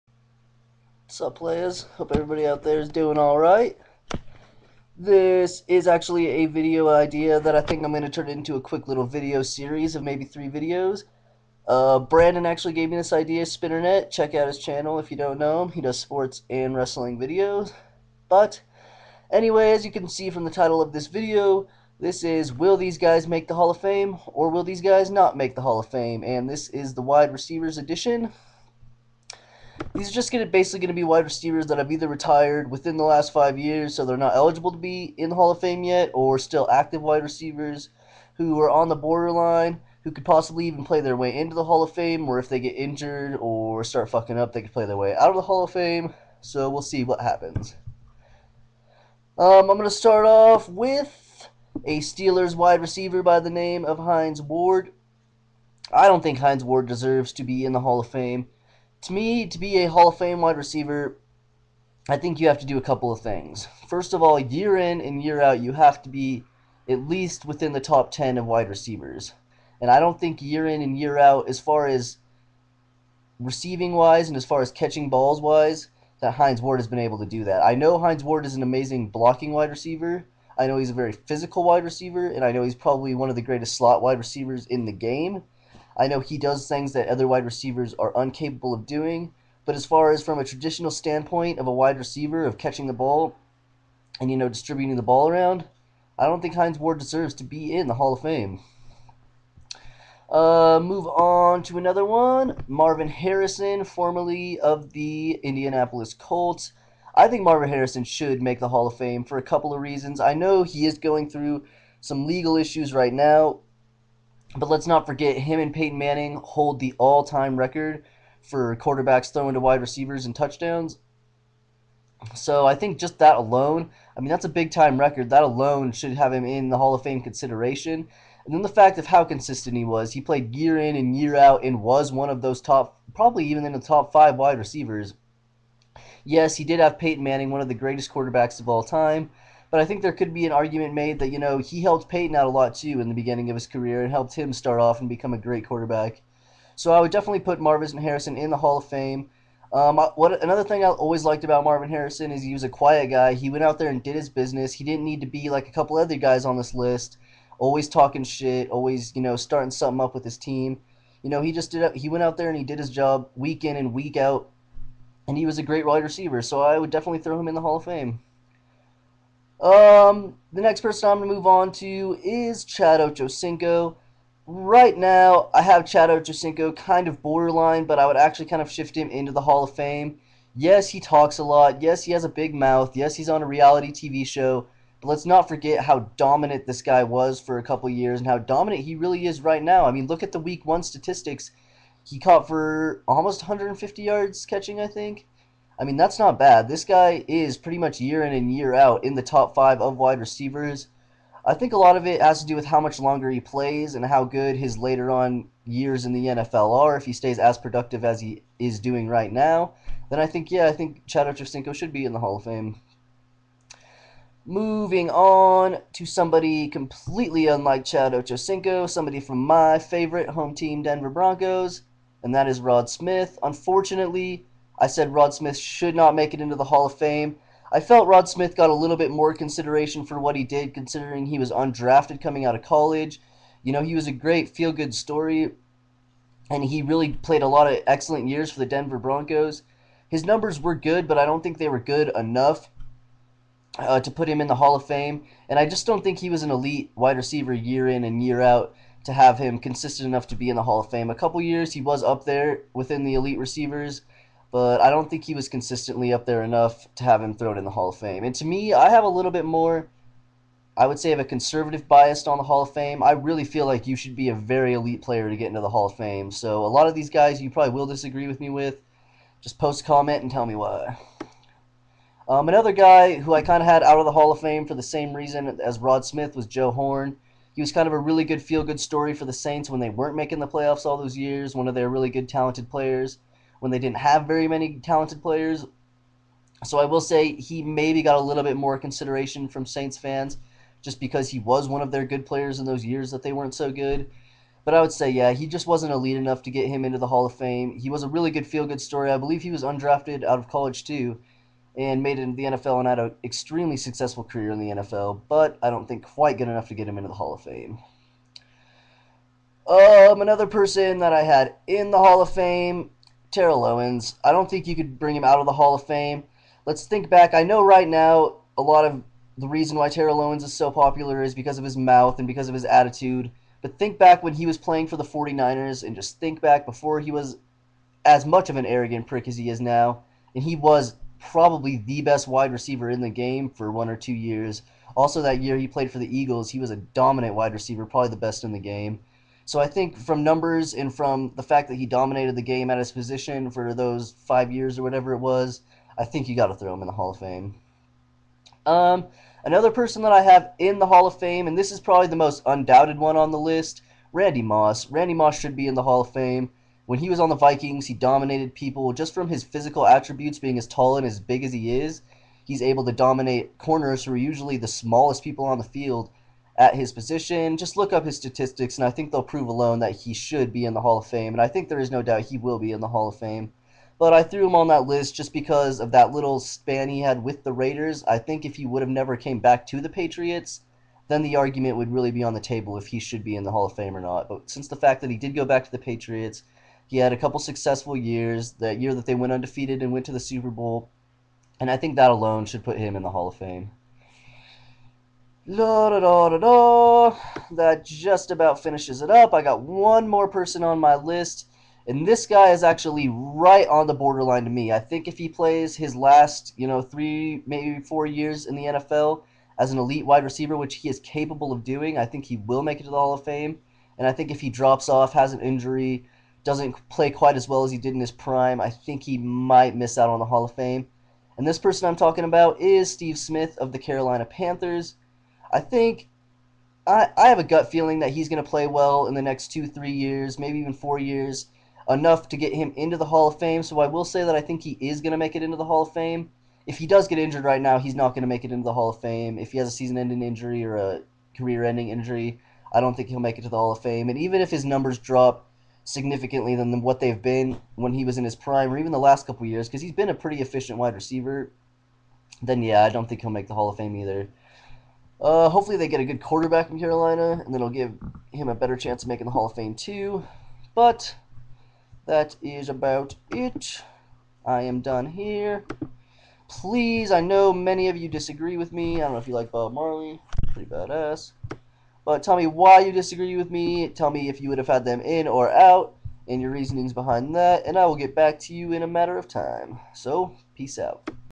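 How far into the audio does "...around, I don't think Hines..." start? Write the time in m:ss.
1:35.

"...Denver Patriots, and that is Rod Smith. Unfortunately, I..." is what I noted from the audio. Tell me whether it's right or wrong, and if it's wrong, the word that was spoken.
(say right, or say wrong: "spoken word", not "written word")
wrong: "Broncos", not "Patriots".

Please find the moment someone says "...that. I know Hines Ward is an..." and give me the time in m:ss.
1:17.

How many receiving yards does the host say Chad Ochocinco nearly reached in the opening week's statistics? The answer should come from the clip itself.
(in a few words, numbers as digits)
150.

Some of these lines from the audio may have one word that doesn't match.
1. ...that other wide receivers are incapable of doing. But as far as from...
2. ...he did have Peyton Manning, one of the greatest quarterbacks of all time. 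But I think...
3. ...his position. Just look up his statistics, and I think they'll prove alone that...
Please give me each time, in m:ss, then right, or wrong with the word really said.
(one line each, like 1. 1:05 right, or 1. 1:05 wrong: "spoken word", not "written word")
1. 1:26 right
2. 2:16 right
3. 6:06 right.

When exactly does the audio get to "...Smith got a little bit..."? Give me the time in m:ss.
3:48.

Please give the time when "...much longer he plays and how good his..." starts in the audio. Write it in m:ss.
3:22.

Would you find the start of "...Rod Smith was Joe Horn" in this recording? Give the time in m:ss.
4:35.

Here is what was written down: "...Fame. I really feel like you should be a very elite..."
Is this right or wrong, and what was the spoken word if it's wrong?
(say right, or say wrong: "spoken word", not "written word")
right.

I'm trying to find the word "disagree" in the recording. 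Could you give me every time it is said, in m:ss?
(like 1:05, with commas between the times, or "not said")
4:27, 7:48, 7:52.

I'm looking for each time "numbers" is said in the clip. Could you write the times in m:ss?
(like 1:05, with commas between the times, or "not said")
4:00, 5:40, 7:24.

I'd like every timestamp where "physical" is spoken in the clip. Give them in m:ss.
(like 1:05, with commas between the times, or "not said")
1:21, 5:59.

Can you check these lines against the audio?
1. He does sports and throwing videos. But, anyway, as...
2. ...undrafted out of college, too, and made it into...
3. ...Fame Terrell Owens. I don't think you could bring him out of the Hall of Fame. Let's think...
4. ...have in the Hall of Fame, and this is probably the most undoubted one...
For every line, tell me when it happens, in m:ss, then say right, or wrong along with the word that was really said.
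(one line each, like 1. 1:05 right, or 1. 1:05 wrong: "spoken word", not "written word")
1. 0:15 wrong: "wrestling", not "throwing"
2. 4:59 right
3. 5:12 right
4. 5:50 right.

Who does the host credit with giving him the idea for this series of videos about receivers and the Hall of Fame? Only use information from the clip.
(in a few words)
Brandon.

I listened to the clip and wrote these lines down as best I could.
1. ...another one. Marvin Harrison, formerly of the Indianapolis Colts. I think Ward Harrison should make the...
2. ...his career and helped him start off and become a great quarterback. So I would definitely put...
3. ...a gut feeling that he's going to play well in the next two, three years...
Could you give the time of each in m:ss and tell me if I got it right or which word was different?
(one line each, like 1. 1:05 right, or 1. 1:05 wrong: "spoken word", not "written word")
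1. 1:41 wrong: "Marvin", not "Ward"
2. 2:23 right
3. 7:07 right.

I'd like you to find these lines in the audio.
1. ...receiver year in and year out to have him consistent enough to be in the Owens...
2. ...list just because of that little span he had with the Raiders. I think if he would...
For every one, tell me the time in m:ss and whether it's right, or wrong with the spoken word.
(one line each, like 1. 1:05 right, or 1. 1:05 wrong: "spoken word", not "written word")
1. 4:07 wrong: "Hall", not "Owens"
2. 6:14 right.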